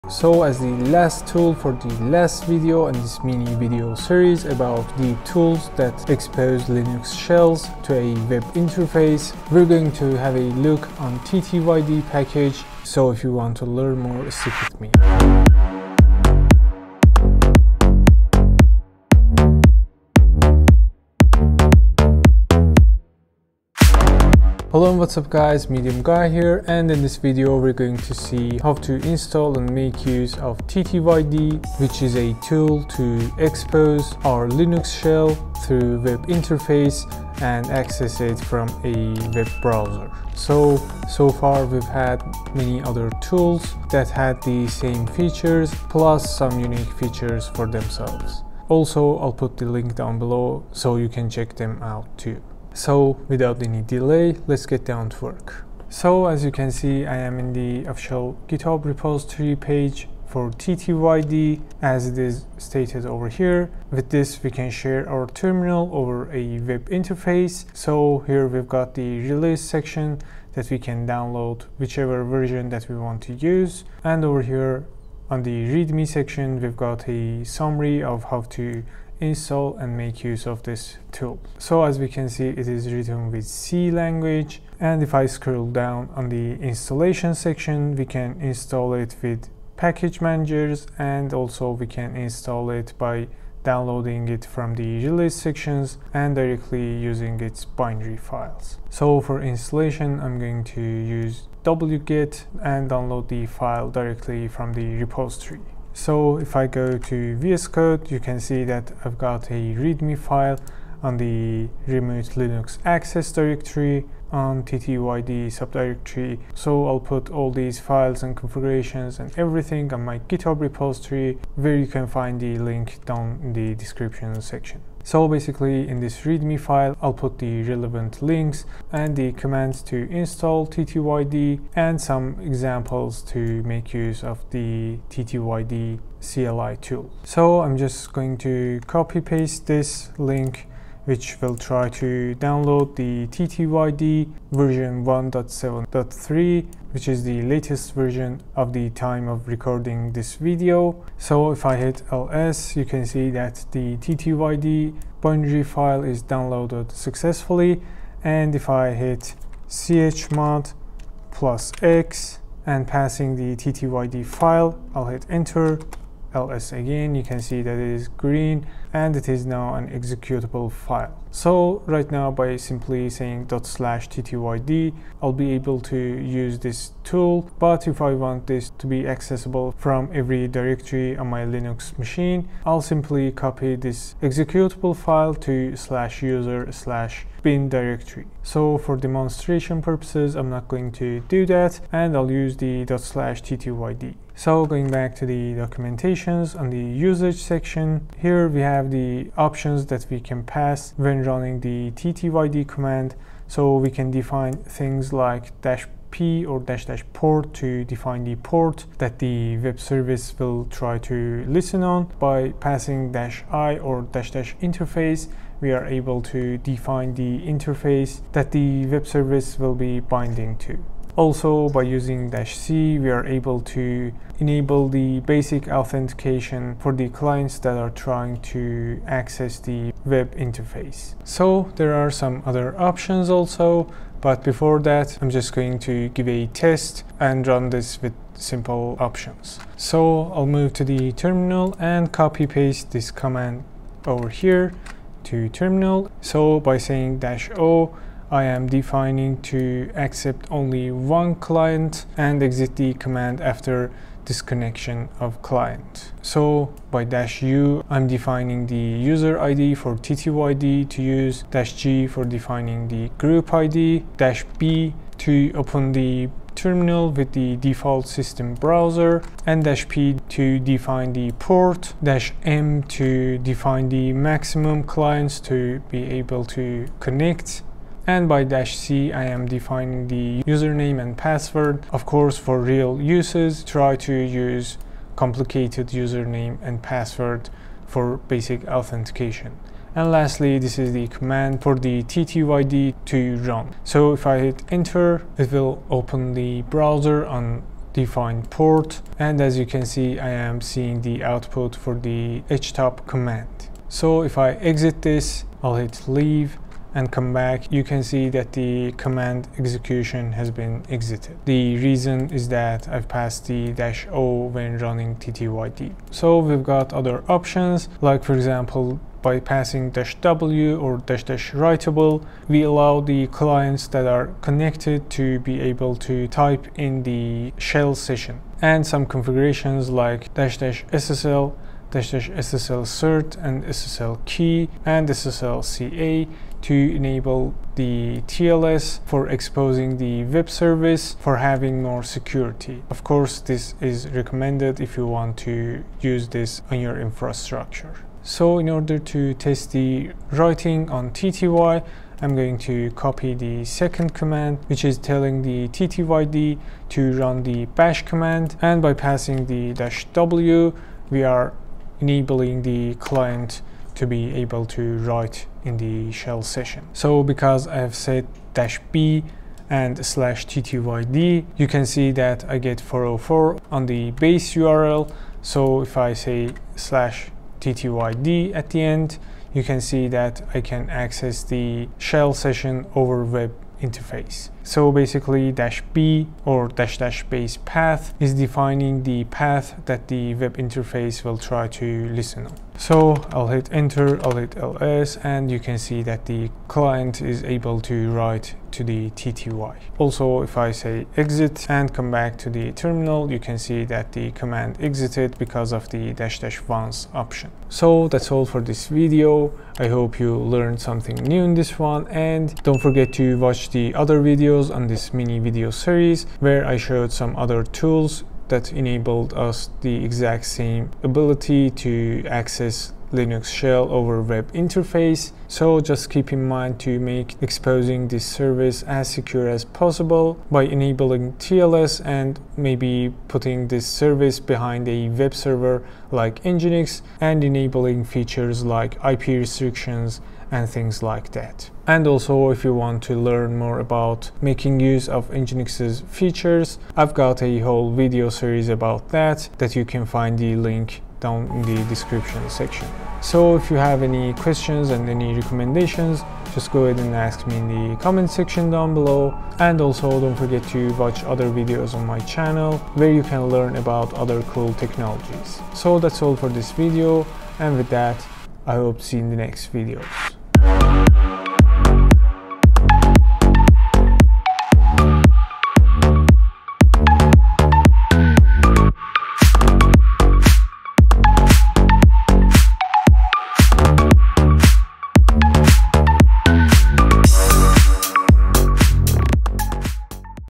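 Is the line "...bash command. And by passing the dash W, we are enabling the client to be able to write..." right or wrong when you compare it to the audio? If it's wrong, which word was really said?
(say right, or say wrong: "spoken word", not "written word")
right.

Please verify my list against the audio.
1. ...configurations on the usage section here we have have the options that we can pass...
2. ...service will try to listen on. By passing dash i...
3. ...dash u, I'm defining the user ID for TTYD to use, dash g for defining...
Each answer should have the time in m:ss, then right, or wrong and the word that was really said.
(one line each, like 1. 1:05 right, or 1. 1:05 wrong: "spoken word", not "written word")
1. 3:15 wrong: "documentations", not "configurations"
2. 3:29 right
3. 4:17 right.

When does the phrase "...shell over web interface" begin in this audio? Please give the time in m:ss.
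7:03.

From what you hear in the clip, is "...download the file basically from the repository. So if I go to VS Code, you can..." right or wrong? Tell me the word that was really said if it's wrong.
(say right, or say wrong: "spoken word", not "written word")
wrong: "directly", not "basically".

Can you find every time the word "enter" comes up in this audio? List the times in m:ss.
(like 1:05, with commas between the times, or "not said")
2:45, 4:54, 6:33.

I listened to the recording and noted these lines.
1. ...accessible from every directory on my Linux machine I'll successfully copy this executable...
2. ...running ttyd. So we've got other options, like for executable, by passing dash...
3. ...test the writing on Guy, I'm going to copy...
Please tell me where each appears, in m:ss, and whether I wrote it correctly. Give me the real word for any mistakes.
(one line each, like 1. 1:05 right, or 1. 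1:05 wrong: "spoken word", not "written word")
1. 2:59 wrong: "simply", not "successfully"
2. 5:14 wrong: "example", not "executable"
3. 5:49 wrong: "TTY", not "Guy".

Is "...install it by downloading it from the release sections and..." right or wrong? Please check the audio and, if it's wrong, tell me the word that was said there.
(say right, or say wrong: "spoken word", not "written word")
right.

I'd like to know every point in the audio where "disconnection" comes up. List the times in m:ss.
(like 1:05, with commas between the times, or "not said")
4:14.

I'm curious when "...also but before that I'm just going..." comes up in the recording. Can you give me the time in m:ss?
3:53.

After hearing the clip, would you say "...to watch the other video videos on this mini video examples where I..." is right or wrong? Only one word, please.
wrong.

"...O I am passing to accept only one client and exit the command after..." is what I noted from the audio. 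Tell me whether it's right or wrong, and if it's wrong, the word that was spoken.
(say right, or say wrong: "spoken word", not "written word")
wrong: "defining", not "passing".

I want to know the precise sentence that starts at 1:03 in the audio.
With this, we can share our terminal over a web interface.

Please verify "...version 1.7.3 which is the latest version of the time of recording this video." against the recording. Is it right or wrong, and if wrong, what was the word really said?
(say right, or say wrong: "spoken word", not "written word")
right.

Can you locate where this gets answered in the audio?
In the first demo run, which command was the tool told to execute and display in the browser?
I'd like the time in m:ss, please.
5:02.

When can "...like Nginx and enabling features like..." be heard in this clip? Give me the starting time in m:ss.
7:16.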